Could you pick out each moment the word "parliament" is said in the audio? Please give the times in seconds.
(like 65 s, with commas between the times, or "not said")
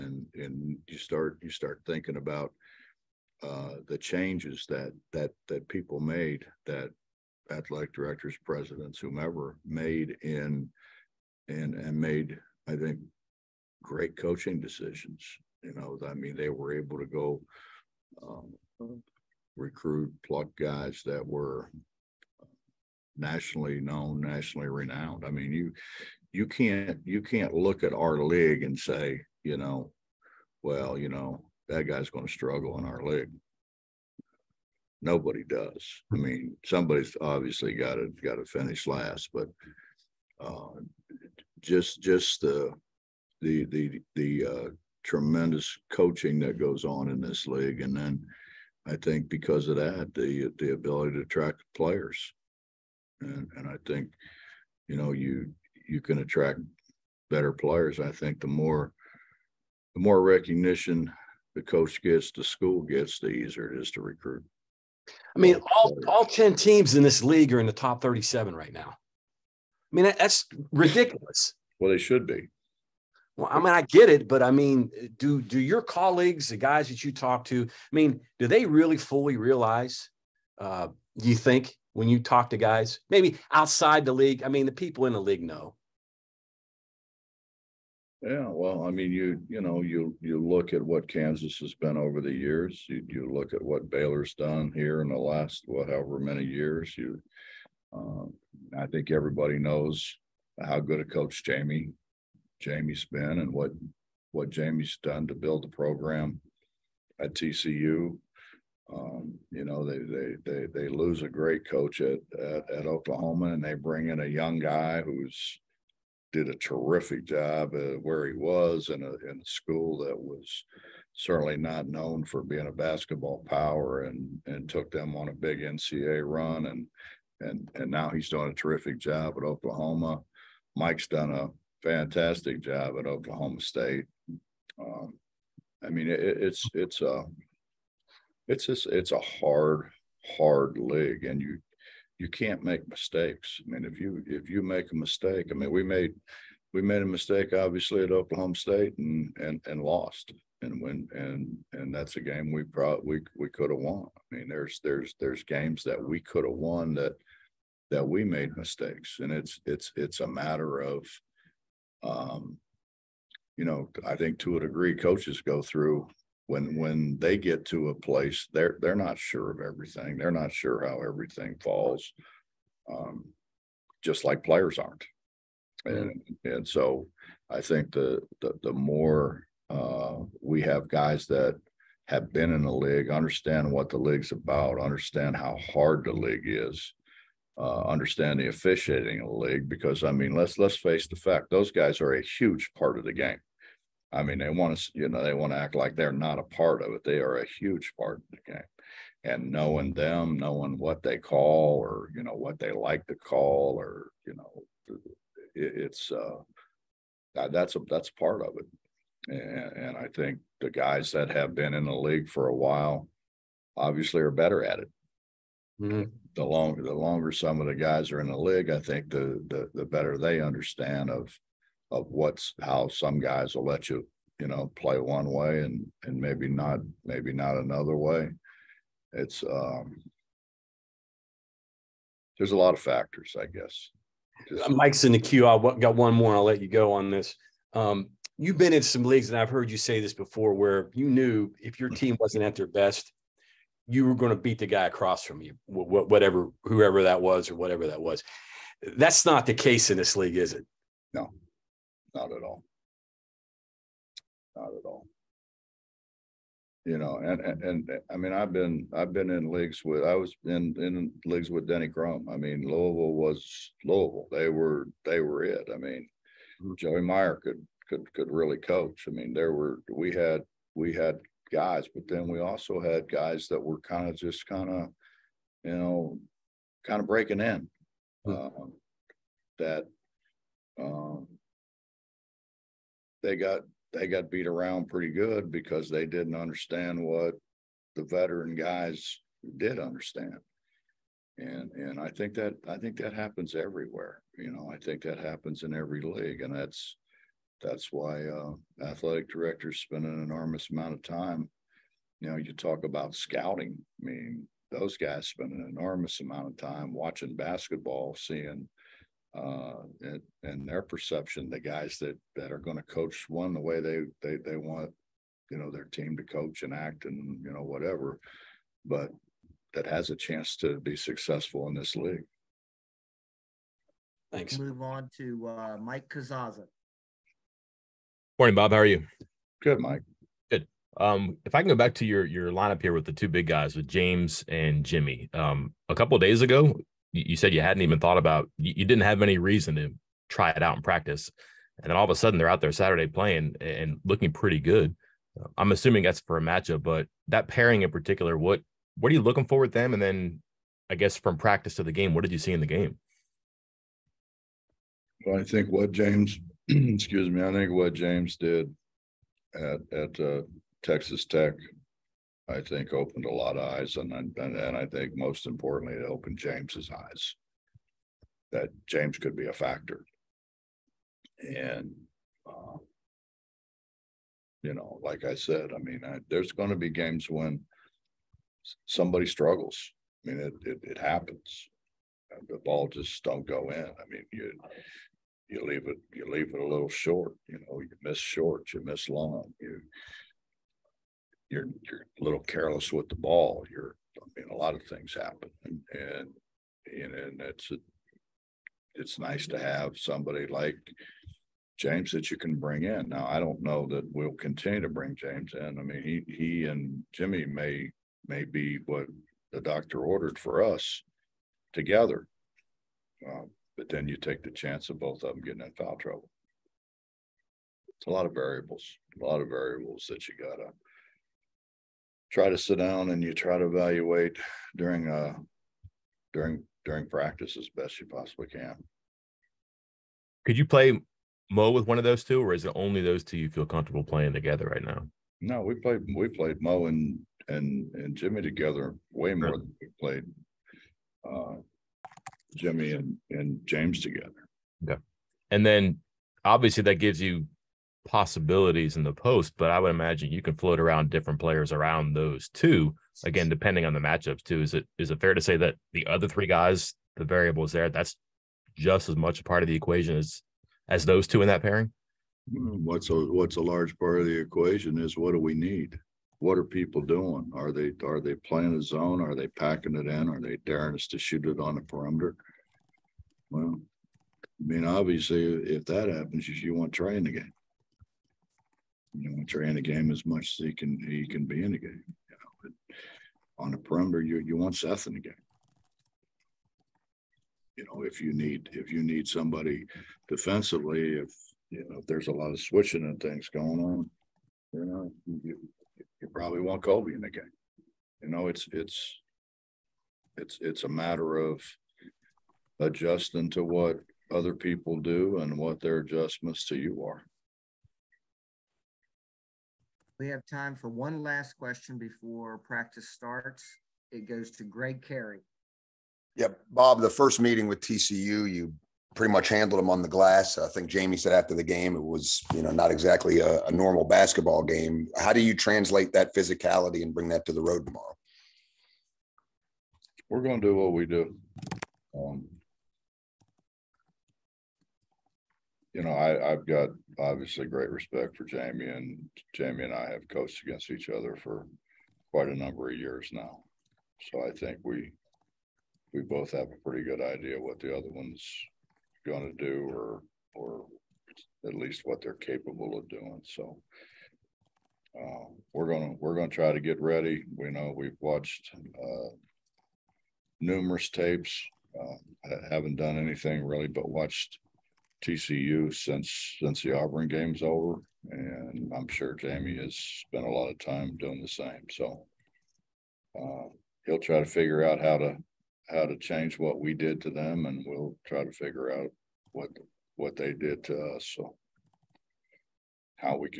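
not said.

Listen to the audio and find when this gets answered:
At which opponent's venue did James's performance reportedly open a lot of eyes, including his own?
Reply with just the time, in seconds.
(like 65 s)
360 s.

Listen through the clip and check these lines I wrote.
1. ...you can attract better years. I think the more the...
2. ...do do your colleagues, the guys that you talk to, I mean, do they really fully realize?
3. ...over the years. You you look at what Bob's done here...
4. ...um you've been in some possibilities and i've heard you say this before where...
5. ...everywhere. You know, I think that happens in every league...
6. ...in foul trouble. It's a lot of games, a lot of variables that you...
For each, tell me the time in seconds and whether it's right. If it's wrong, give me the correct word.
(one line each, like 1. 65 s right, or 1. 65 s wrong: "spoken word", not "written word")
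1. 55 s wrong: "players", not "years"
2. 75 s right
3. 91 s wrong: "Baylor", not "Bob"
4. 237 s wrong: "leagues", not "possibilities"
5. 293 s right
6. 415 s wrong: "variables", not "games".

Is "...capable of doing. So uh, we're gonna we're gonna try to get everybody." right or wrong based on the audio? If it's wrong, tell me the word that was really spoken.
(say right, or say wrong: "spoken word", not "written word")
wrong: "ready", not "everybody".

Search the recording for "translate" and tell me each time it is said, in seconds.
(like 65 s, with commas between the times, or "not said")
525 s.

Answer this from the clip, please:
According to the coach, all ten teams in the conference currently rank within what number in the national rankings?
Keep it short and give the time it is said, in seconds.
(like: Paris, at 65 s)
Top 37, at 67 s.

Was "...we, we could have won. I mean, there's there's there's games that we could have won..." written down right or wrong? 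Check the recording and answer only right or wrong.
right.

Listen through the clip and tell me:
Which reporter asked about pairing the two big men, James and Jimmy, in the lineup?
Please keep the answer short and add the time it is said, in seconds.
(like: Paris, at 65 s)
Mike Casazza, at 325 s.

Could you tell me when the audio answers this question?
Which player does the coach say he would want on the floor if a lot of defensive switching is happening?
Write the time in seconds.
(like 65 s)
496 s.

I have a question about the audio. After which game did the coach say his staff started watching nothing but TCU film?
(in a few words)
Auburn.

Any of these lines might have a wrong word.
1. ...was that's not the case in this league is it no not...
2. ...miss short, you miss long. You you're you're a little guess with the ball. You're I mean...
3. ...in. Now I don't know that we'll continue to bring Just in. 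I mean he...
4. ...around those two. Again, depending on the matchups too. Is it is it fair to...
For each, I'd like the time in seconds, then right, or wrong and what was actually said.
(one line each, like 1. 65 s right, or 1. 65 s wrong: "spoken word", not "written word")
1. 248 s right
2. 388 s wrong: "careless", not "guess"
3. 402 s wrong: "James", not "Just"
4. 451 s right.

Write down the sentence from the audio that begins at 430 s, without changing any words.
Could you play Mo with one of those two, or is it only those two you feel comfortable playing together right now?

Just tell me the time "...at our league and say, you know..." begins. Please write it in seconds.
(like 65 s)
27 s.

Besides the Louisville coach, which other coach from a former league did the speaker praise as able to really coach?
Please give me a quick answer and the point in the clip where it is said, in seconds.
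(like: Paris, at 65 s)
Joey Meyer, at 266 s.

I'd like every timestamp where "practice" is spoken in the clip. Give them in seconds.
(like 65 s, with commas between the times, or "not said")
340 s, 351 s, 427 s, 512 s.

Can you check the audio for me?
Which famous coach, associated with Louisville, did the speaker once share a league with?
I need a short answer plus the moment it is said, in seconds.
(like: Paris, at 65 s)
Denny Crum, at 261 s.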